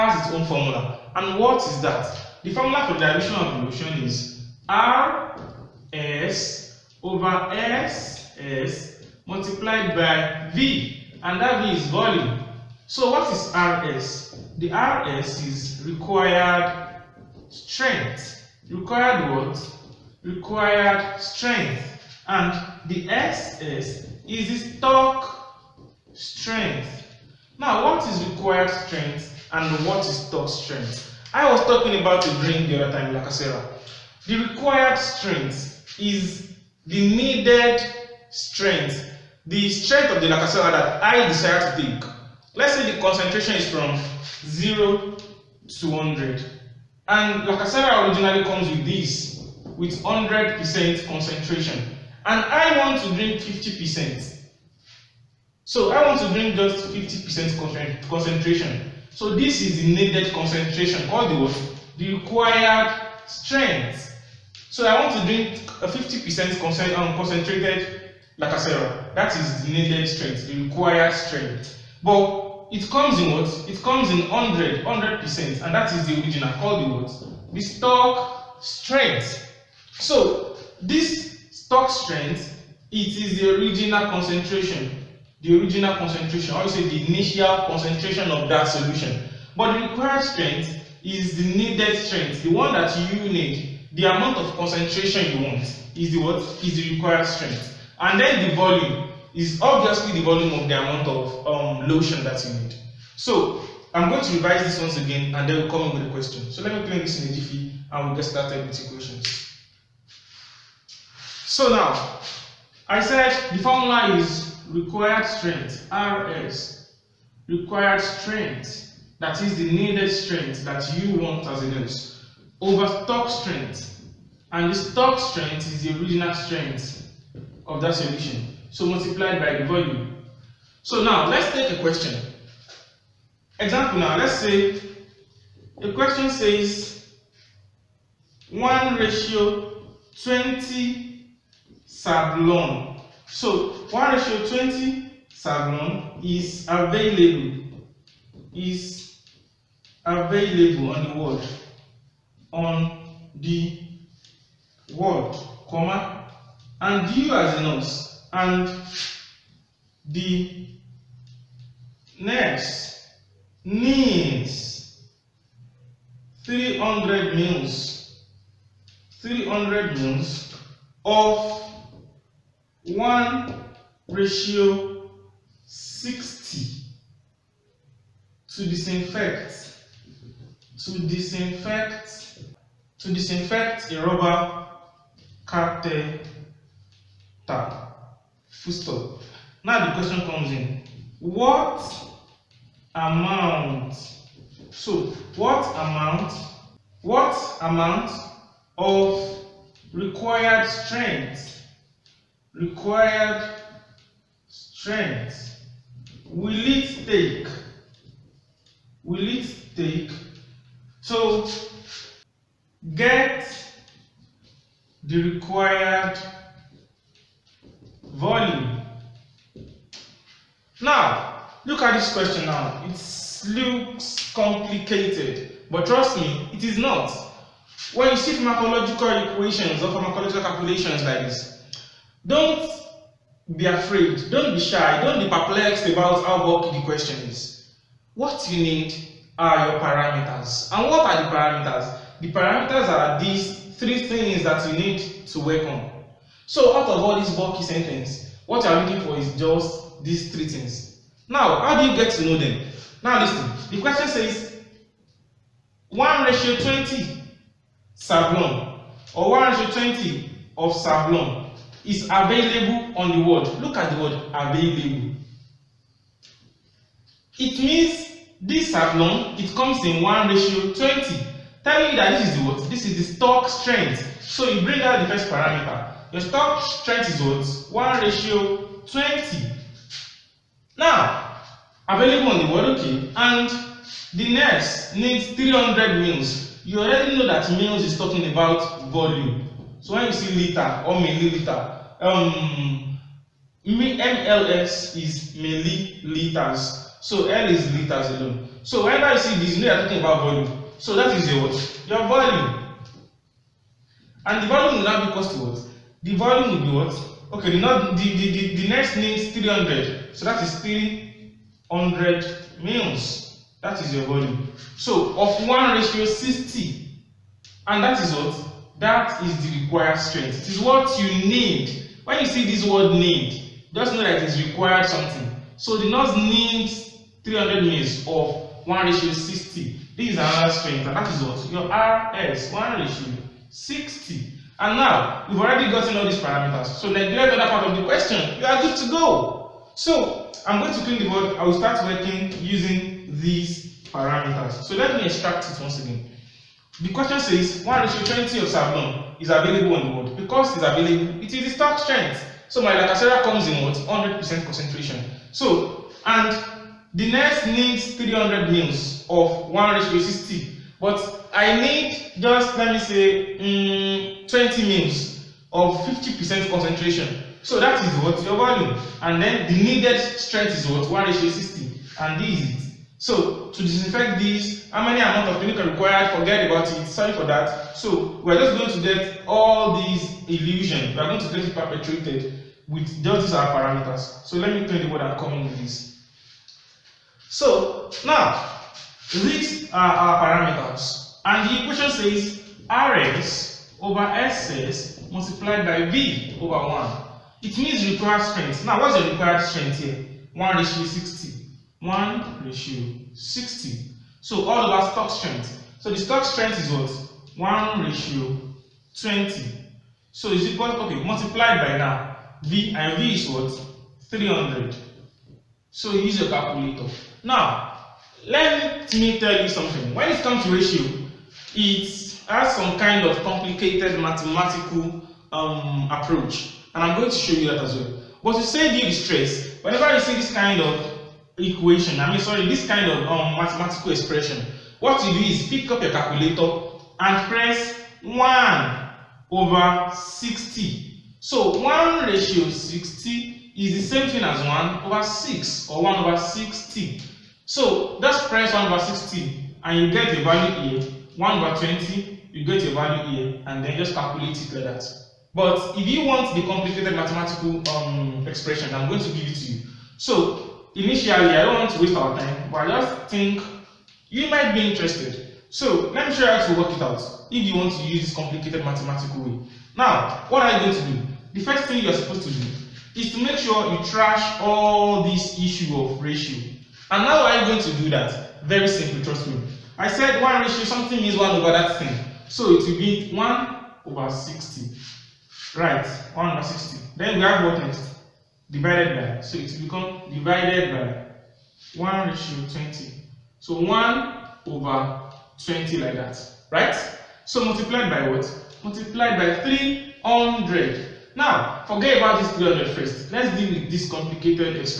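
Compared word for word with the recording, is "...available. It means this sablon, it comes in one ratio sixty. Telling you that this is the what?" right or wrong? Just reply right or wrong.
wrong.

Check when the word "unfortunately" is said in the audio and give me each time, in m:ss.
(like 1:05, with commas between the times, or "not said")
not said.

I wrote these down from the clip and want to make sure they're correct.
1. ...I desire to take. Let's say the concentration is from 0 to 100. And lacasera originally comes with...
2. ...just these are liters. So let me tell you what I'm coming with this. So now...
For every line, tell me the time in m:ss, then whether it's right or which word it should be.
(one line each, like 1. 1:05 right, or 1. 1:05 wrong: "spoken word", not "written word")
1. 0:41 right
2. 6:23 wrong: "parameters", not "liters".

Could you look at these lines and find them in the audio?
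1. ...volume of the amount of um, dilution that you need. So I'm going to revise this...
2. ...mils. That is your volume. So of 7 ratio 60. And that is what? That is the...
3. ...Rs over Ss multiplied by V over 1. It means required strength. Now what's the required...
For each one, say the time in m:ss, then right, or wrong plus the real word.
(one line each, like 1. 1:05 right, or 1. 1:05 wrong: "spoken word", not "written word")
1. 1:40 wrong: "lotion", not "dilution"
2. 5:12 wrong: "1", not "7"
3. 6:32 right.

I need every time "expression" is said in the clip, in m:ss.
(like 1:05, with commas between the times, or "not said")
7:13, 7:38.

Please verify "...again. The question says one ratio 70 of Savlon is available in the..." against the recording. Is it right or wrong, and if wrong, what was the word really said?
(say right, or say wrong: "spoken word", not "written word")
wrong: "20", not "70".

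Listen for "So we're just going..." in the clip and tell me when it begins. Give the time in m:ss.
6:17.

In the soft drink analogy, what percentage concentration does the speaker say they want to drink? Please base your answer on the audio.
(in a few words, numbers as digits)
50%.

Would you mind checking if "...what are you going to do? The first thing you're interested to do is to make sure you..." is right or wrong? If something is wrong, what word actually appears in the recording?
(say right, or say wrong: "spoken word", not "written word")
wrong: "supposed", not "interested".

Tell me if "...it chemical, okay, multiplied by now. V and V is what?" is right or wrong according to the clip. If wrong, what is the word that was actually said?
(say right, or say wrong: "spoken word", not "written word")
wrong: "equal", not "chemical".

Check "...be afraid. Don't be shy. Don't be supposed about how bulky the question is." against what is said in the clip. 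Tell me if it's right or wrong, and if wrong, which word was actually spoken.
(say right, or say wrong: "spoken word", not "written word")
wrong: "perplexed", not "supposed".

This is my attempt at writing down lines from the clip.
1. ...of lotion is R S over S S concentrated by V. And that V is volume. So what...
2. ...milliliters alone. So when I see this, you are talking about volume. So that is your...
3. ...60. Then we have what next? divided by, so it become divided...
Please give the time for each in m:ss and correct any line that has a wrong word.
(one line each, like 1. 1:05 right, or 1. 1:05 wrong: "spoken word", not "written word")
1. 0:03 wrong: "multiplied", not "concentrated"
2. 4:57 wrong: "liters", not "milliliters"
3. 8:06 right.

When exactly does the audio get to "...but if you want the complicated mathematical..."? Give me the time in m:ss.
7:35.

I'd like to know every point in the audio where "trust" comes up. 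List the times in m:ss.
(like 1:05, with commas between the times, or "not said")
3:45, 7:59.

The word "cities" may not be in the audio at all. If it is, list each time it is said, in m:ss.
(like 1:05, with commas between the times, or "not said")
not said.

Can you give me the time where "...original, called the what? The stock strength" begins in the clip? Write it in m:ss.
1:16.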